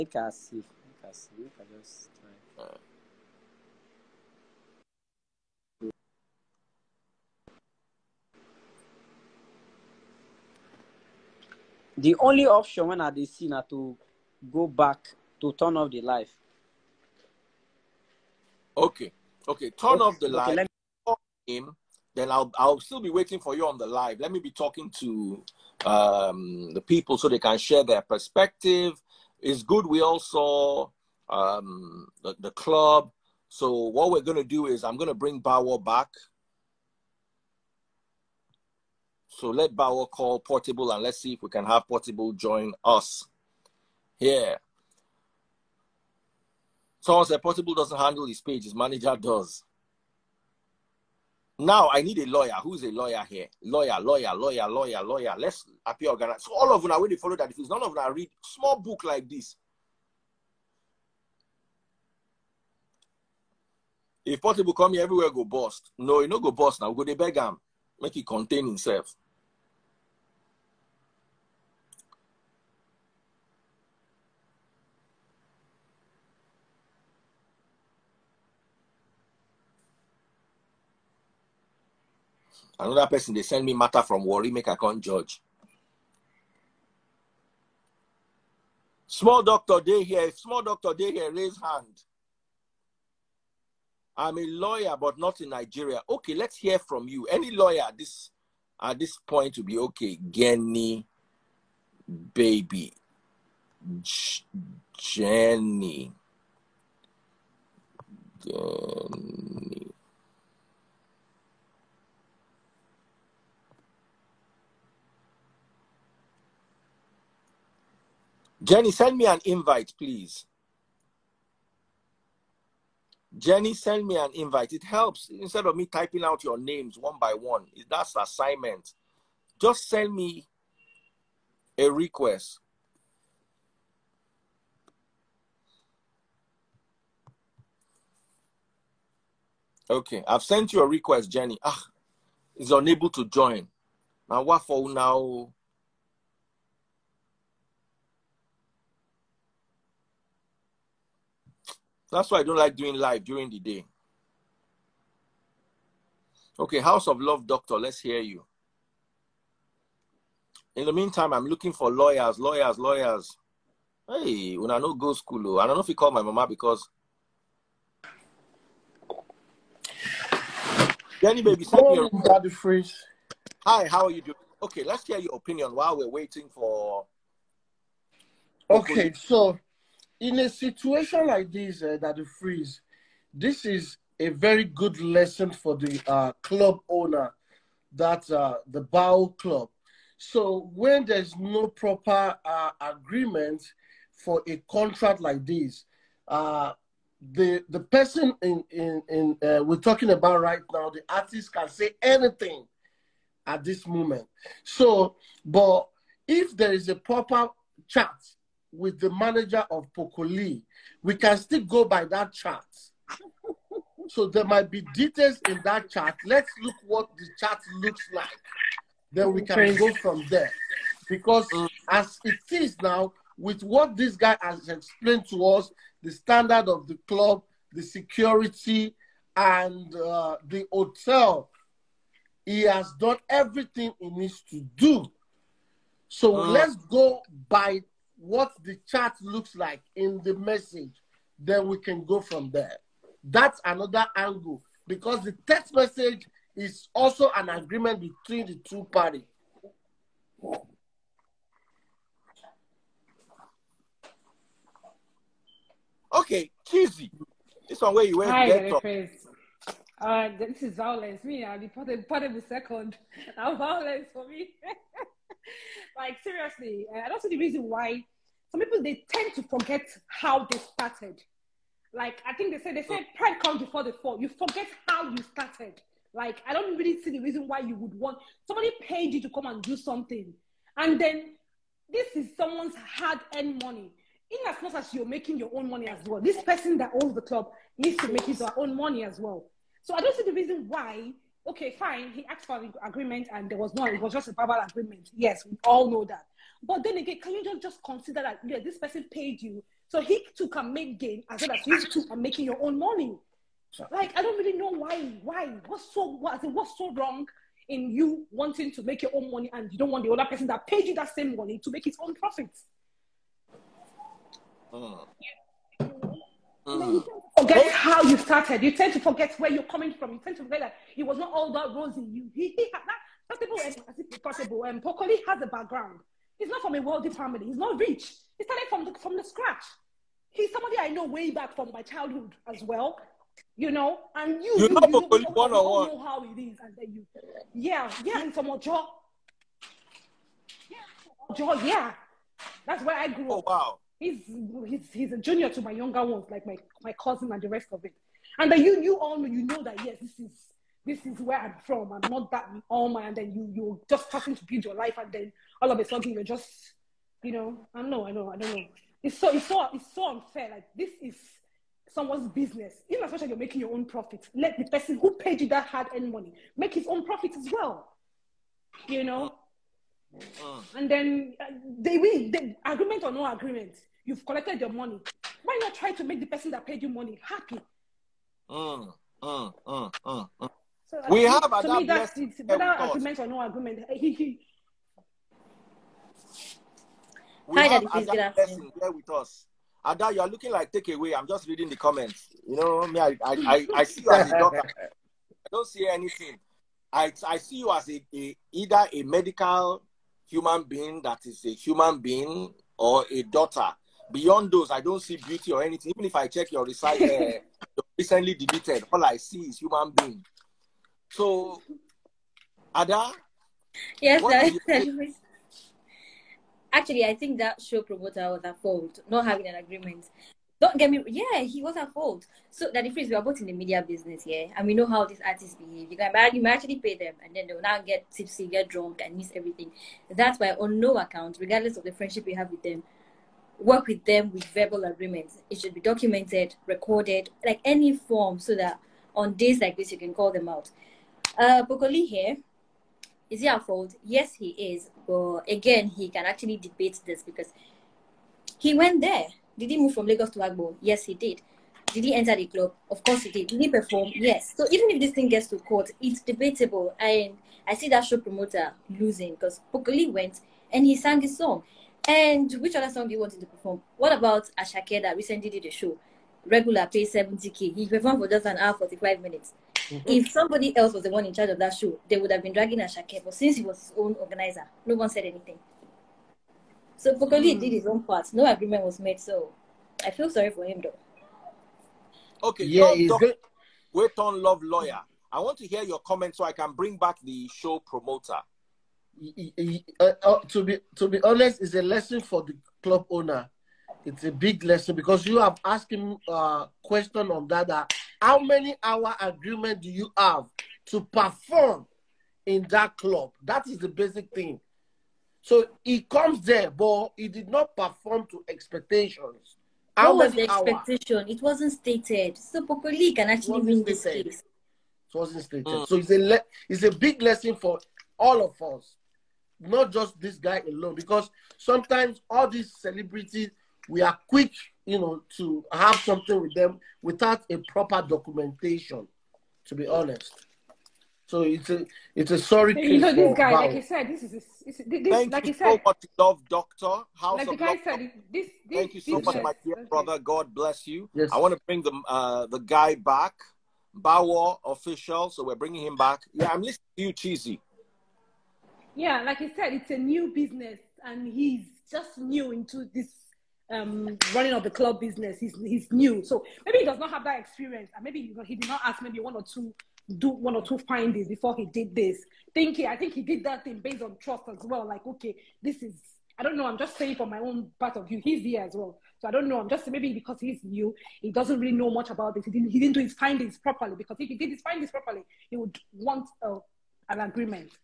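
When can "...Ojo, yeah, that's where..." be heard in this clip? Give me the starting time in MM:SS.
05:41.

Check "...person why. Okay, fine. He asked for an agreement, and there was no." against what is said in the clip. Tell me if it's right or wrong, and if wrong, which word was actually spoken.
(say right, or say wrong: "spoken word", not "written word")
wrong: "reason", not "person".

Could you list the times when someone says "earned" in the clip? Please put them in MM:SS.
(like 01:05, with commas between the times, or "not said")
04:42, 06:05.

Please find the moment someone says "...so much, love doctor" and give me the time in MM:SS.
08:55.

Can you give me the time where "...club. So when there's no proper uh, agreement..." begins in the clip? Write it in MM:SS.
03:09.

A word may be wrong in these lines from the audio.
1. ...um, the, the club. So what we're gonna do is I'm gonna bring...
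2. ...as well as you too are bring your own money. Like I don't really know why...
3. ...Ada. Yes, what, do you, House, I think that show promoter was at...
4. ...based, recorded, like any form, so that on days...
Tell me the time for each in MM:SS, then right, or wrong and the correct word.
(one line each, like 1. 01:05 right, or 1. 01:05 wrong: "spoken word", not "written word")
1. 00:31 right
2. 05:01 wrong: "making", not "bring"
3. 06:52 wrong: "Actually", not "House"
4. 07:15 wrong: "documented", not "based".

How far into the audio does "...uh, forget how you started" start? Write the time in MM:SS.
05:16.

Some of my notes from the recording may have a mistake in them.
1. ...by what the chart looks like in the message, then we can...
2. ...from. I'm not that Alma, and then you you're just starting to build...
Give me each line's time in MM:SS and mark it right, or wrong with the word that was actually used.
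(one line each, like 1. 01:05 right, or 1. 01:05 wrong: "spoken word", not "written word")
1. 03:57 right
2. 05:51 right.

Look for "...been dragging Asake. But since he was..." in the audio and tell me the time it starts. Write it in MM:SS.
07:52.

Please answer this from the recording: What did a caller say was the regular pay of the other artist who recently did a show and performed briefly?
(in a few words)
70k.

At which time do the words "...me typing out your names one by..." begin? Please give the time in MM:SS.
02:05.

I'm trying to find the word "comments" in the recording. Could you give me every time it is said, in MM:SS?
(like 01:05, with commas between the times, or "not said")
06:31, 08:05.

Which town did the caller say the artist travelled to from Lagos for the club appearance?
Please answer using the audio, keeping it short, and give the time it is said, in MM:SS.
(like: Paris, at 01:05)
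Agbor, at 07:30.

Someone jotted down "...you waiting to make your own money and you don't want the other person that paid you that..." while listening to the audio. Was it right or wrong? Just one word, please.
wrong.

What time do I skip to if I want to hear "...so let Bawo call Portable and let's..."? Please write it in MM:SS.
00:39.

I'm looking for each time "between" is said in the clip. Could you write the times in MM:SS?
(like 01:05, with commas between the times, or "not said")
04:07.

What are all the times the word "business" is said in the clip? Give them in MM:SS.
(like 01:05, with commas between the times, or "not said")
06:02, 07:03, 09:10, 09:14.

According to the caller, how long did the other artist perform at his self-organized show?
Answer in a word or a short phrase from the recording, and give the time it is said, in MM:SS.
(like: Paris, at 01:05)
an hour 45 minutes, at 07:48.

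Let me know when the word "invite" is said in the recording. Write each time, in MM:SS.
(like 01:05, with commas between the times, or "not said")
01:59, 02:04.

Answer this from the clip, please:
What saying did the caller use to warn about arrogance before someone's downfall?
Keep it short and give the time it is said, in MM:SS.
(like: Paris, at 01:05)
Pride comes before the fall, at 04:33.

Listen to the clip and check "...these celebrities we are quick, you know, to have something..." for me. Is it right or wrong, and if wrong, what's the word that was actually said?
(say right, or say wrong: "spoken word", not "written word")
right.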